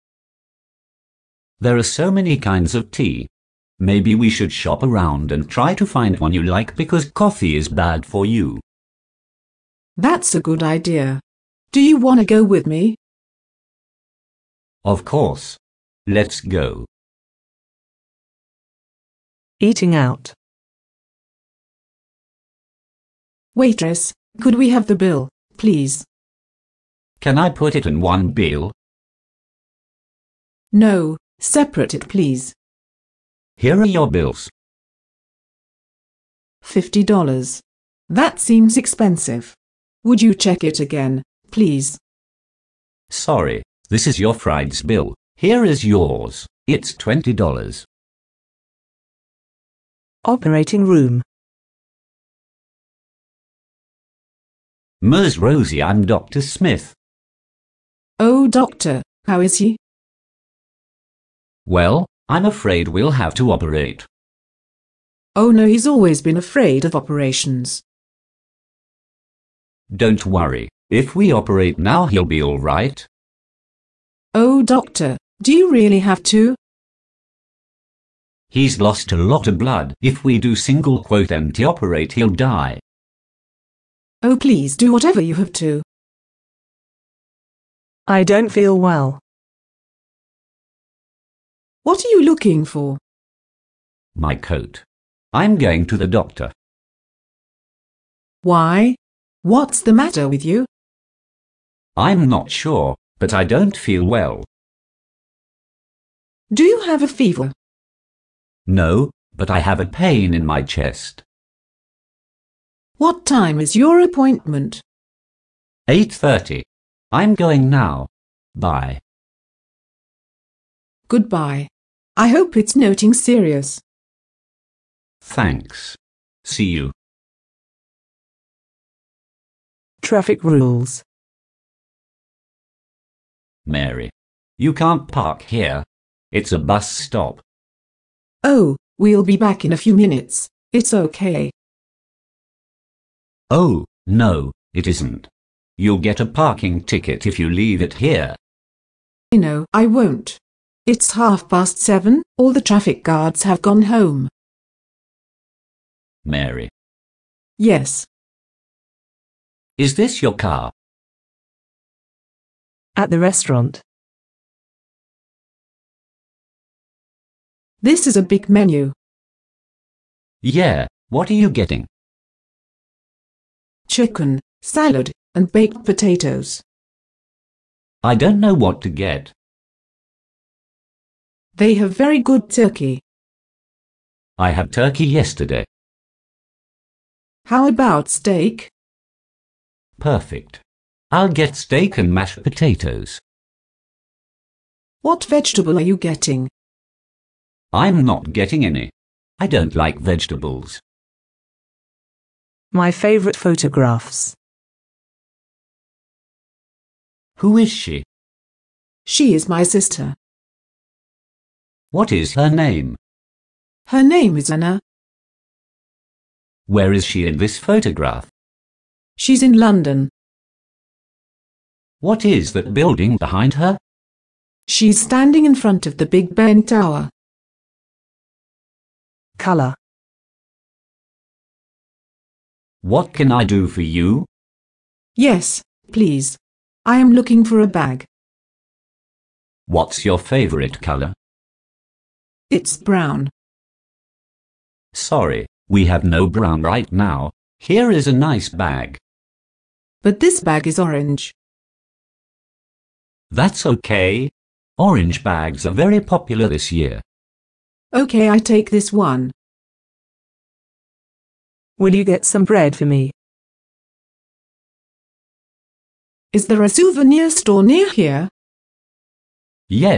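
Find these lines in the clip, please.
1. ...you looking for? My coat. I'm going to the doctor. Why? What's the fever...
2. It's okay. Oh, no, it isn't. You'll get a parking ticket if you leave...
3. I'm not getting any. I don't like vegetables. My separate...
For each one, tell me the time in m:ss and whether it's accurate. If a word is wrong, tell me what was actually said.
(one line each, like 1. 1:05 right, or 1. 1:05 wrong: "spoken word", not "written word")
1. 1:32 wrong: "matter", not "fever"
2. 2:20 right
3. 3:17 wrong: "favorite", not "separate".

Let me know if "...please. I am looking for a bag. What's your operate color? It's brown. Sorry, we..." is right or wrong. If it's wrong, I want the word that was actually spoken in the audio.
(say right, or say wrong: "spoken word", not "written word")
wrong: "favorite", not "operate".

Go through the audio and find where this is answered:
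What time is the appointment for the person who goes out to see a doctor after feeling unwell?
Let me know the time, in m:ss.
1:55.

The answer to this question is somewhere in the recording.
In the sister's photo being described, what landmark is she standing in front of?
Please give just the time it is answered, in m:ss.
3:46.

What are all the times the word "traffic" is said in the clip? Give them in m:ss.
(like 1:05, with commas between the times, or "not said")
2:10, 2:32.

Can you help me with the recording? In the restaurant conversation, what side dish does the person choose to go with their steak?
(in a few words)
Mashed potatoes.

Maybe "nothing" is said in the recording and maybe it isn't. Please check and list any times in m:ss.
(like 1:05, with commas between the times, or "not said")
2:02.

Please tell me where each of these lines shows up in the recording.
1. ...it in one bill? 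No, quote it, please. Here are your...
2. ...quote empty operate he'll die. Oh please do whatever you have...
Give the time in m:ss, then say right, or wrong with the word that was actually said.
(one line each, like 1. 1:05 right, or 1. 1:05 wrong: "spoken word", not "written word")
1. 0:27 wrong: "separate", not "quote"
2. 1:21 right.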